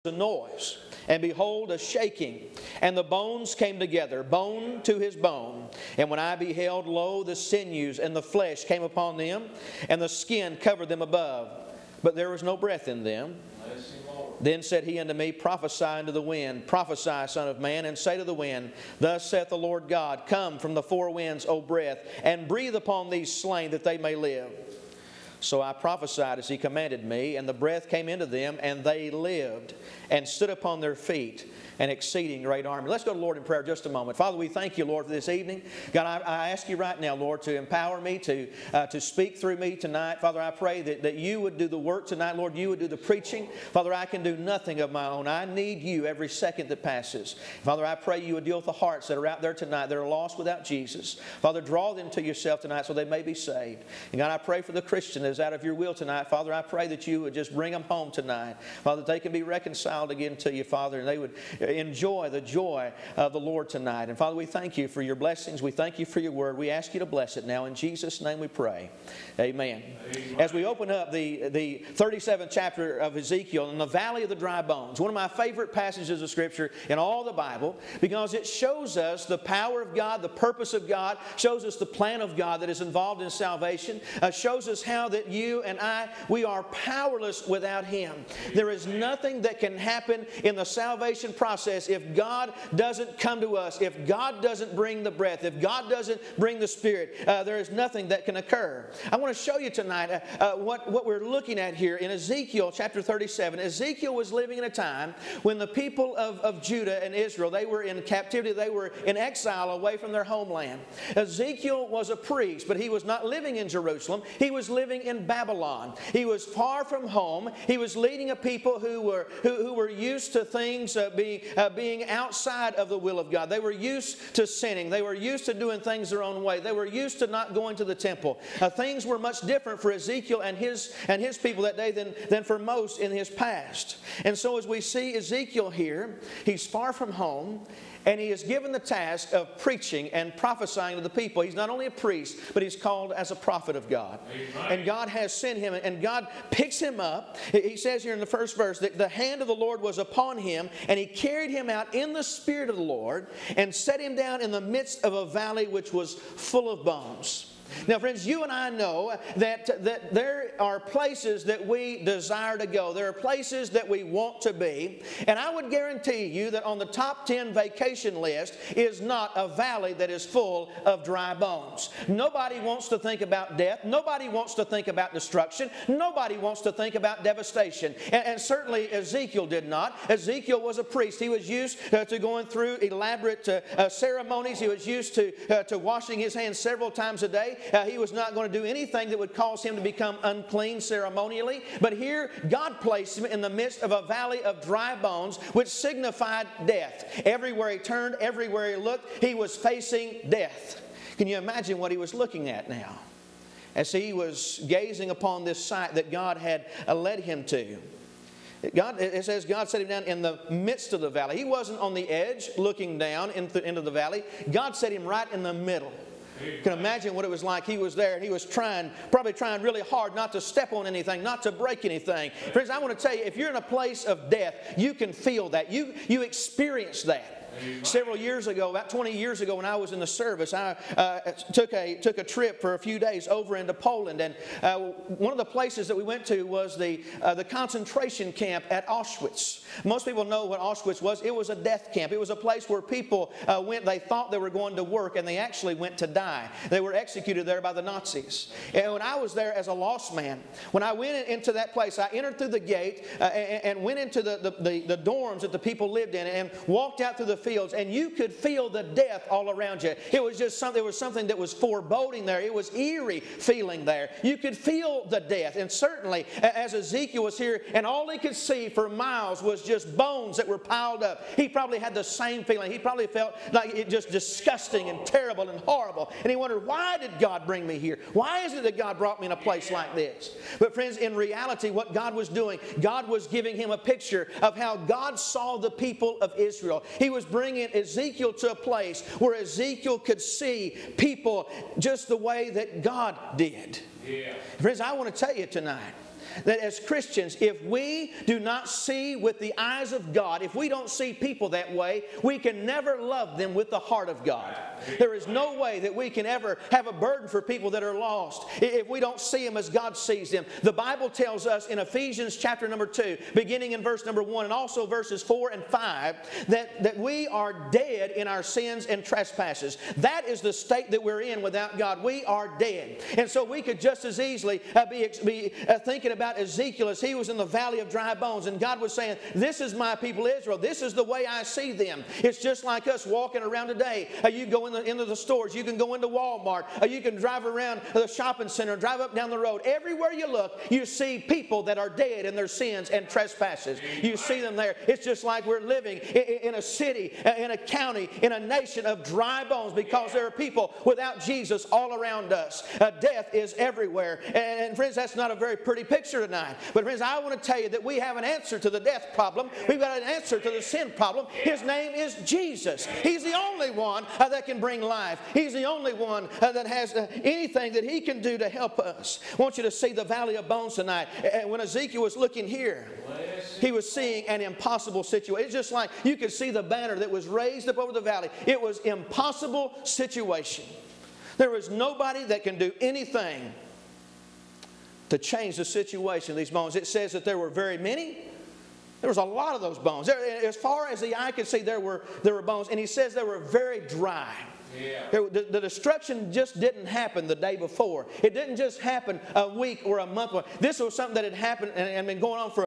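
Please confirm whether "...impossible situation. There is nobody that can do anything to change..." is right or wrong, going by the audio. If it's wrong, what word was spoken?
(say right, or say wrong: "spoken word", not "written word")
right.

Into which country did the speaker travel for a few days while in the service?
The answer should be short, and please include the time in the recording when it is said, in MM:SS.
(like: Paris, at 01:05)
Poland, at 03:53.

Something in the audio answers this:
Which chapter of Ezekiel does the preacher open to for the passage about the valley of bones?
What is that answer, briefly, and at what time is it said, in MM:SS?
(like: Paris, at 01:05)
37th, at 01:11.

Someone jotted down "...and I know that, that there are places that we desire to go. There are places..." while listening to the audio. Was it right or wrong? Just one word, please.
right.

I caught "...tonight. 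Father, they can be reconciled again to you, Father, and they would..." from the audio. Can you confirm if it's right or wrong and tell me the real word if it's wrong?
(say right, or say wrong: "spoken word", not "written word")
right.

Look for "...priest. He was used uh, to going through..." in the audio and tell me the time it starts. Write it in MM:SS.
03:00.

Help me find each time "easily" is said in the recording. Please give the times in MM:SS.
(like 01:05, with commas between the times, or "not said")
05:24.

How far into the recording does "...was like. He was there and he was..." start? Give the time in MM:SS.
03:37.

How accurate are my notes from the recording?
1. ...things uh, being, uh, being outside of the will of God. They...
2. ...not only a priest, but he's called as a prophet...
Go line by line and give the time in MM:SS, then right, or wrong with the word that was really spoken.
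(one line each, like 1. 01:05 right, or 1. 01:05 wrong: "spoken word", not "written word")
1. 02:00 right
2. 02:21 right.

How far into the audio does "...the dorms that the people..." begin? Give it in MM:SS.
04:14.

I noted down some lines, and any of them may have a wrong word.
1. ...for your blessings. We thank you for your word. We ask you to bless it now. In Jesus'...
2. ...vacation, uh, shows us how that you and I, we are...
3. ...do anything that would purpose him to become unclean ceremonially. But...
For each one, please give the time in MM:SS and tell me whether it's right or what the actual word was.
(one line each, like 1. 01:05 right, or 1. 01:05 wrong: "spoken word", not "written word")
1. 01:04 right
2. 01:23 wrong: "salvation", not "vacation"
3. 03:08 wrong: "cause", not "purpose".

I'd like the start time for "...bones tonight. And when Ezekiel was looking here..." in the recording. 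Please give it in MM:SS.
06:10.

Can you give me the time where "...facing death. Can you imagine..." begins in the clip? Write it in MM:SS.
03:19.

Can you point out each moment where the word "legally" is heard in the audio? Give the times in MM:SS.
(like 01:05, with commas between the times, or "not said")
not said.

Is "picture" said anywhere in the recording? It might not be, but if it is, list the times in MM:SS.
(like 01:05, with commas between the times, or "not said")
04:43, 05:55.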